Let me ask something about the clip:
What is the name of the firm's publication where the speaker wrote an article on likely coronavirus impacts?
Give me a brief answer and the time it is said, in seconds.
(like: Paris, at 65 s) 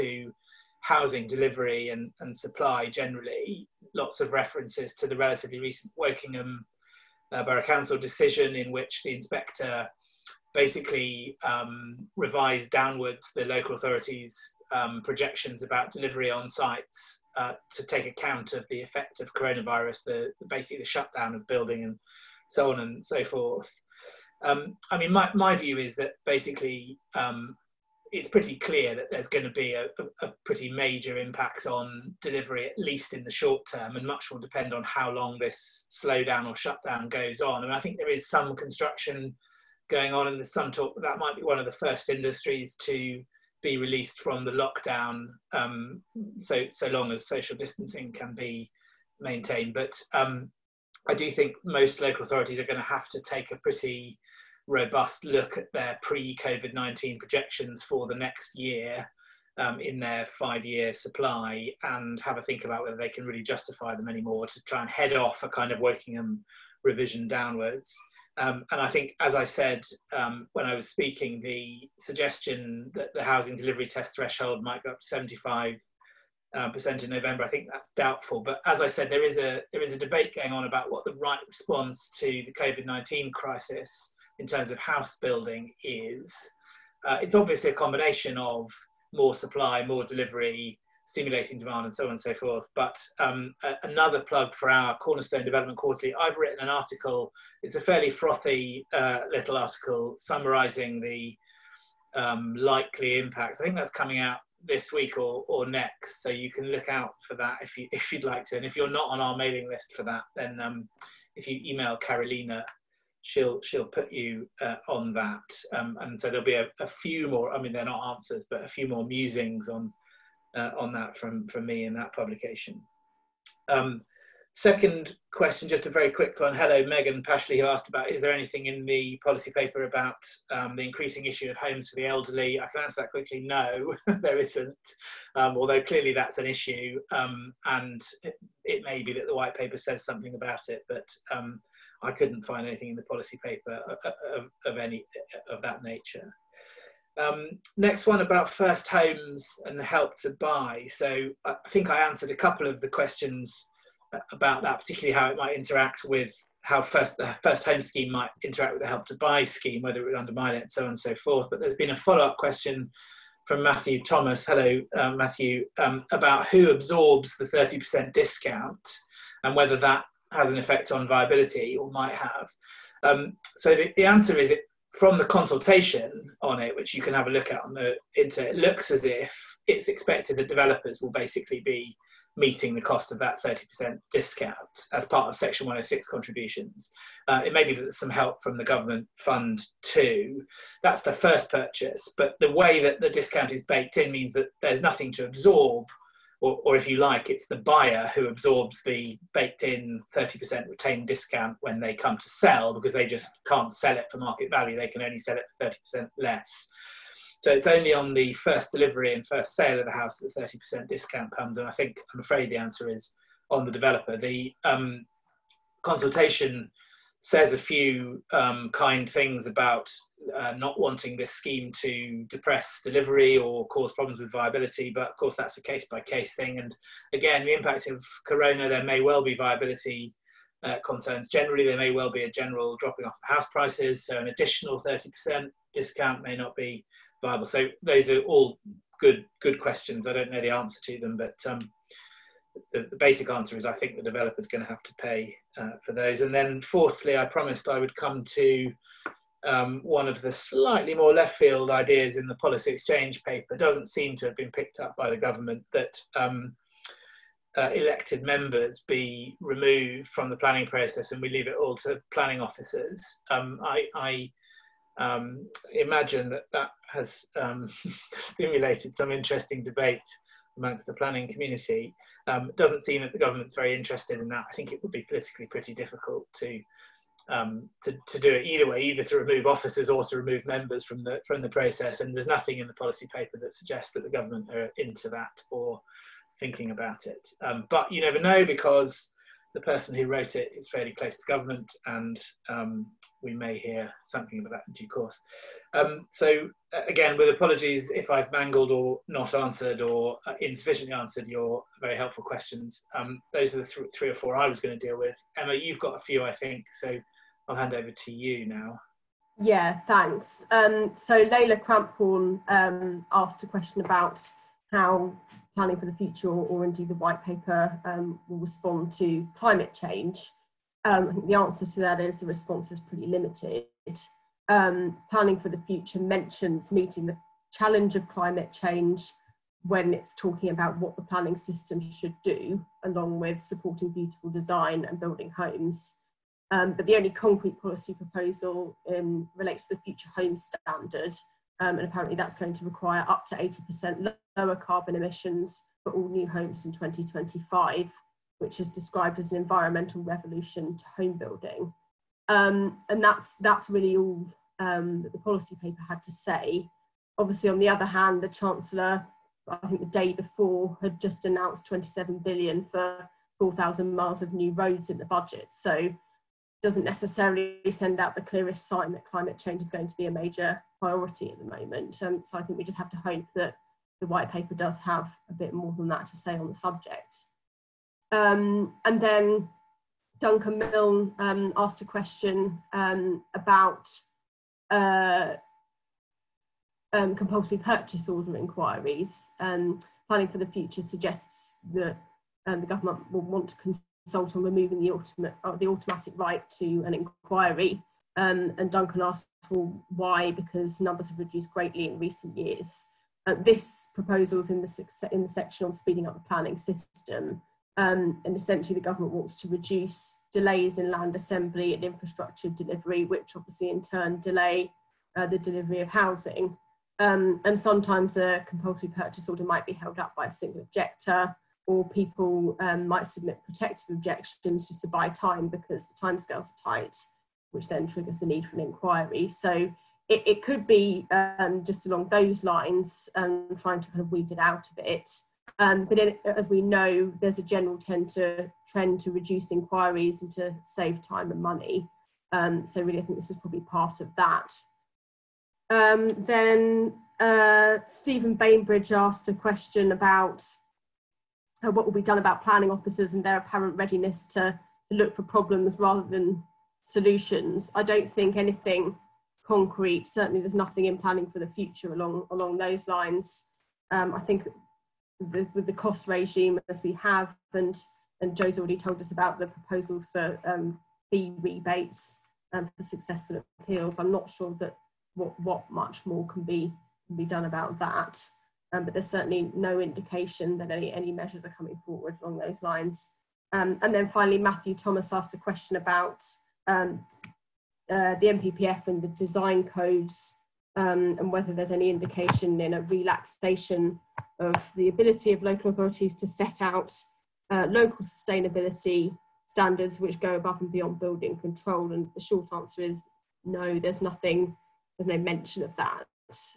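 Cornerstone Development Quarterly, at 94 s.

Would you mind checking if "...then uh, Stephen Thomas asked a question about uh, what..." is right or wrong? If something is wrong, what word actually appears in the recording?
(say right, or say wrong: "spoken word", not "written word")
wrong: "Bainbridge", not "Thomas".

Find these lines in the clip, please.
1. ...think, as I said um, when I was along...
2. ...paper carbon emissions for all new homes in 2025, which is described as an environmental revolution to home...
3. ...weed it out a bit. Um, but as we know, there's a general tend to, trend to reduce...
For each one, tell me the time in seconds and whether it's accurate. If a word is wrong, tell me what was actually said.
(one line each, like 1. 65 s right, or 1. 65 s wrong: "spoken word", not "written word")
1. 68 s wrong: "speaking", not "along"
2. 344 s wrong: "lower", not "paper"
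3. 434 s right.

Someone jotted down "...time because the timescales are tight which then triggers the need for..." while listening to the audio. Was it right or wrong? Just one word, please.
right.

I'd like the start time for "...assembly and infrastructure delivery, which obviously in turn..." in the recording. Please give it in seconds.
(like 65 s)
411 s.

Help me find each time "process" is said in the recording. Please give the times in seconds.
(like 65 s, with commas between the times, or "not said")
260 s, 281 s.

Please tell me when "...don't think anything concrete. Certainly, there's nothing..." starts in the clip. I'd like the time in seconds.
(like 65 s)
457 s.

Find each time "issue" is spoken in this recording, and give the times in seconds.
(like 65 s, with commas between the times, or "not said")
131 s, 136 s.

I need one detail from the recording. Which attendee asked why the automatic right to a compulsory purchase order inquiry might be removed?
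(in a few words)
Duncan Milne.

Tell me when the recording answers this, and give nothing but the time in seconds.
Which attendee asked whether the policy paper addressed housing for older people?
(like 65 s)
126 s.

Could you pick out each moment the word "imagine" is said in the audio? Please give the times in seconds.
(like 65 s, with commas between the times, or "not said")
265 s.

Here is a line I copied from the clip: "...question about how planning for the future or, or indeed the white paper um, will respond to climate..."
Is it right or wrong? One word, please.
right.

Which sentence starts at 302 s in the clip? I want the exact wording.
Um, those are the th three or four I was going to deal with.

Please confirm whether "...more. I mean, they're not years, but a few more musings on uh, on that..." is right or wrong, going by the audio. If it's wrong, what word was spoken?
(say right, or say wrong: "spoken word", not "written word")
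wrong: "answers", not "years".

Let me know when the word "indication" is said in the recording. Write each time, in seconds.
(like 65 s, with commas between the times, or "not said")
479 s, 491 s.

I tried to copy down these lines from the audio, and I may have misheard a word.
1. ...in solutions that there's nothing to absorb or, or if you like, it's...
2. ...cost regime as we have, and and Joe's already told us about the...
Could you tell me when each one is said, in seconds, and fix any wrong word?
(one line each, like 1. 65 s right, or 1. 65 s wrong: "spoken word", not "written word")
1. 193 s wrong: "means", not "solutions"
2. 465 s right.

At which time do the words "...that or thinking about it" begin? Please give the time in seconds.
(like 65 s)
285 s.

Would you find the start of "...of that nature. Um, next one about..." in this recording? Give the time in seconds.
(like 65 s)
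145 s.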